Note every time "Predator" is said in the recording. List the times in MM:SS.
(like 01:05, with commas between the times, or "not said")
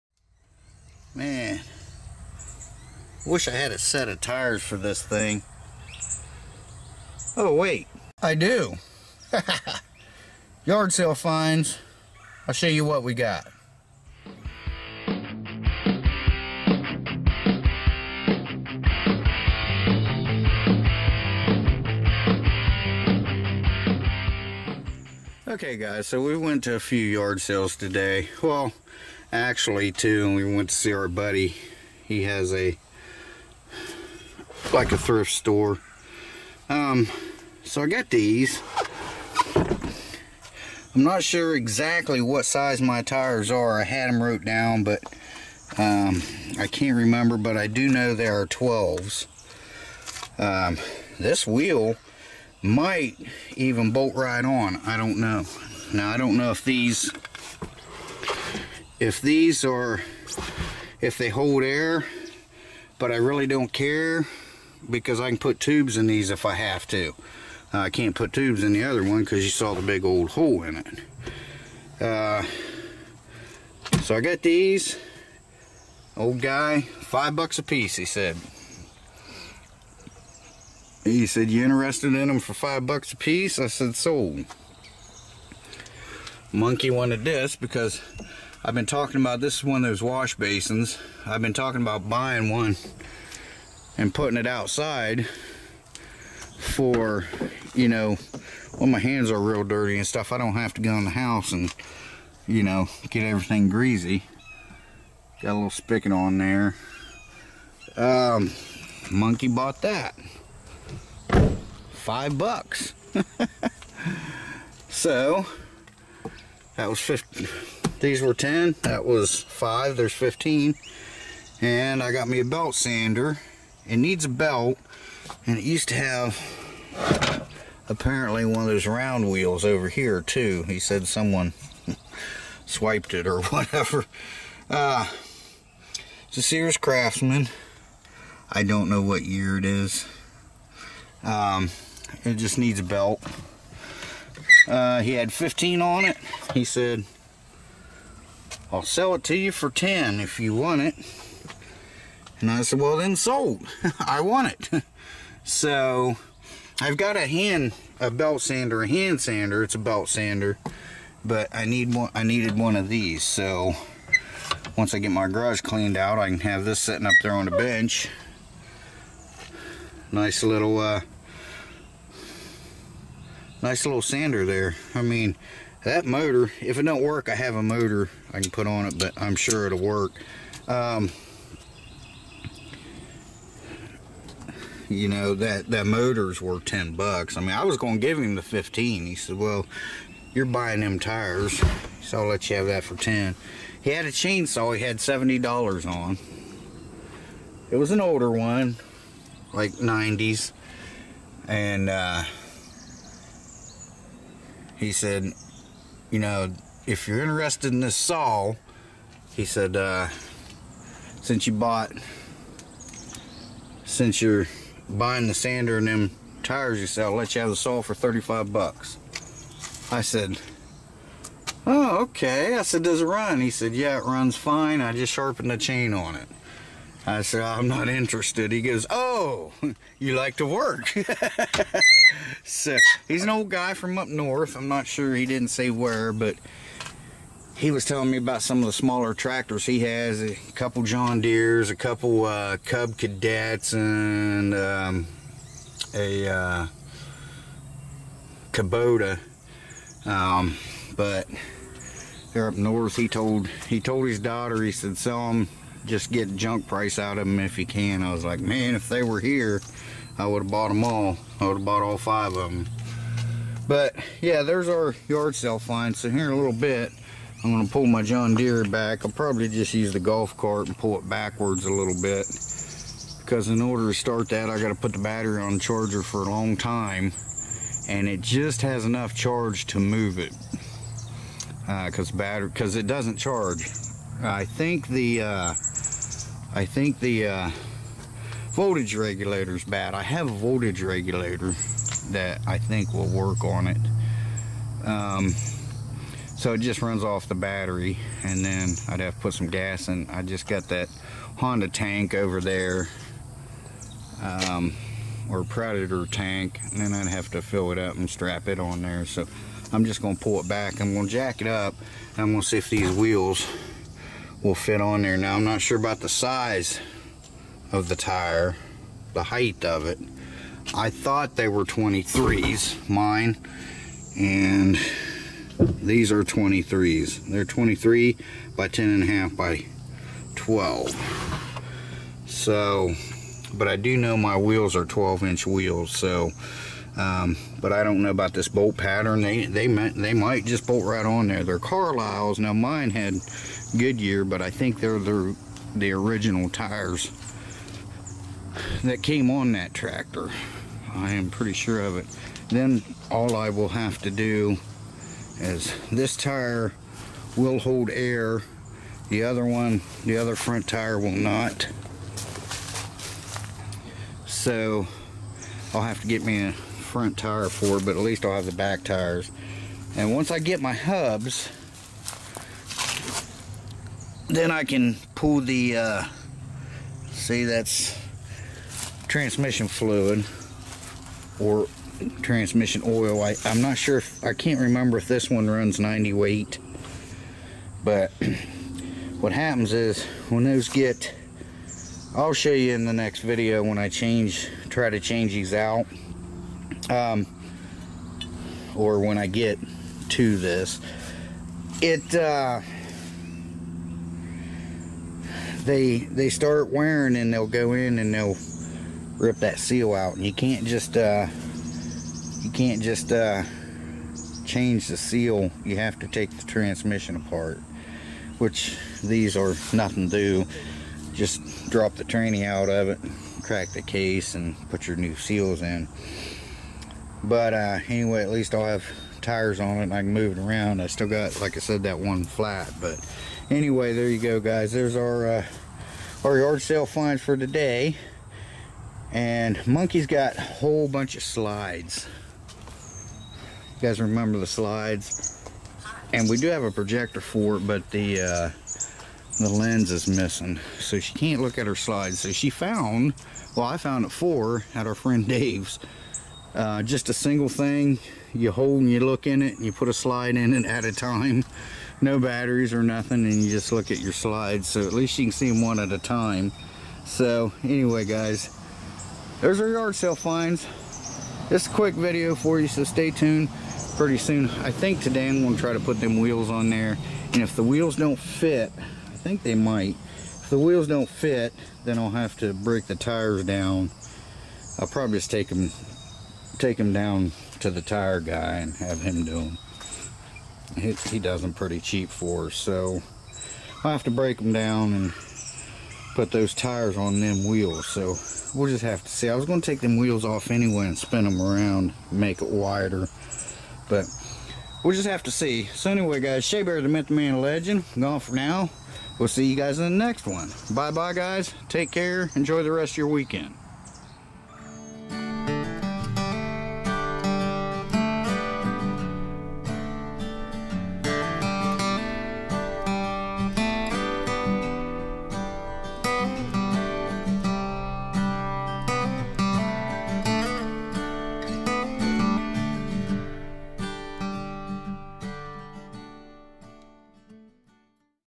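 05:05.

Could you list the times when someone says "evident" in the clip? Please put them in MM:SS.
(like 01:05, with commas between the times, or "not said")
not said.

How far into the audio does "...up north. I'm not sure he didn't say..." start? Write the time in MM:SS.
03:53.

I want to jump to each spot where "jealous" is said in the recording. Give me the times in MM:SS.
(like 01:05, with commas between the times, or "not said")
not said.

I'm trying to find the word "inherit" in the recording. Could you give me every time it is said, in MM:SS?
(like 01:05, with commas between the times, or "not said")
not said.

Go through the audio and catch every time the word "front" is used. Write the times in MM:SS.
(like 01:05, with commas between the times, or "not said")
06:00, 06:06.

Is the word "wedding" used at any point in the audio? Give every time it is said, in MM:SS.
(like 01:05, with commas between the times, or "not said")
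not said.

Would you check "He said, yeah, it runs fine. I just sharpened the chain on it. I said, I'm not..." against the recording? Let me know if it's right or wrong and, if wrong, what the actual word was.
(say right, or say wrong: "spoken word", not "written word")
right.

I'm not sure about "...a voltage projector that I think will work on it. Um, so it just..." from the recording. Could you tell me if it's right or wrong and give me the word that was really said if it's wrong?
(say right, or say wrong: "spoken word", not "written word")
wrong: "regulator", not "projector".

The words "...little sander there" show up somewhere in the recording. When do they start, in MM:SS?
02:53.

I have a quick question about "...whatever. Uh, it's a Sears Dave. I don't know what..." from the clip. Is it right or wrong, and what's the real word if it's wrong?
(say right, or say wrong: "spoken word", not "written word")
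wrong: "Craftsman", not "Dave".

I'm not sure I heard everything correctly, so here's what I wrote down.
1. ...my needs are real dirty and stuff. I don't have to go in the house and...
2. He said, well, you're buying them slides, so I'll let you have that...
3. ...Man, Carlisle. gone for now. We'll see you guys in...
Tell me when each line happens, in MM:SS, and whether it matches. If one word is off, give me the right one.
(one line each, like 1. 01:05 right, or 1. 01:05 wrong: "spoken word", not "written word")
1. 01:38 wrong: "hands", not "needs"
2. 03:09 wrong: "tires", not "slides"
3. 08:27 wrong: "Legend", not "Carlisle".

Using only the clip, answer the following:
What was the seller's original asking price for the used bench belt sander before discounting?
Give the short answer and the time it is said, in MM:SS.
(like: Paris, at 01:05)
15, at 02:25.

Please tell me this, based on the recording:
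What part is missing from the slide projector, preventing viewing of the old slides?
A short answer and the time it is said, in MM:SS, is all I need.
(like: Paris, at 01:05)
the lens, at 07:29.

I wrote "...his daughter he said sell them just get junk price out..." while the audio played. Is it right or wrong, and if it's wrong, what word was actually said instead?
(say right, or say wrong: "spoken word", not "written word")
right.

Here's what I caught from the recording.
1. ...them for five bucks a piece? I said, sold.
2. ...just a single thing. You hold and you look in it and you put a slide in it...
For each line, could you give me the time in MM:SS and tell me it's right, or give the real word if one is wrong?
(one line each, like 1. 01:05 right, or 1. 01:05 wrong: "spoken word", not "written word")
1. 01:22 right
2. 07:36 right.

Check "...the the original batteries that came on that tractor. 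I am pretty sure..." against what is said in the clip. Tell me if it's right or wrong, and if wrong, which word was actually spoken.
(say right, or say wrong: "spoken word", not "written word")
wrong: "tires", not "batteries".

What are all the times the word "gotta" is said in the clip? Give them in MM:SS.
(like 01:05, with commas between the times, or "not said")
04:34.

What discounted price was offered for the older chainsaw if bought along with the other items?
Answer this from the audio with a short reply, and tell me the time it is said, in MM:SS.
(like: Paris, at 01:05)
35, at 03:37.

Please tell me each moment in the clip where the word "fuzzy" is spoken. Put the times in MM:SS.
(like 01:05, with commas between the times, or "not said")
not said.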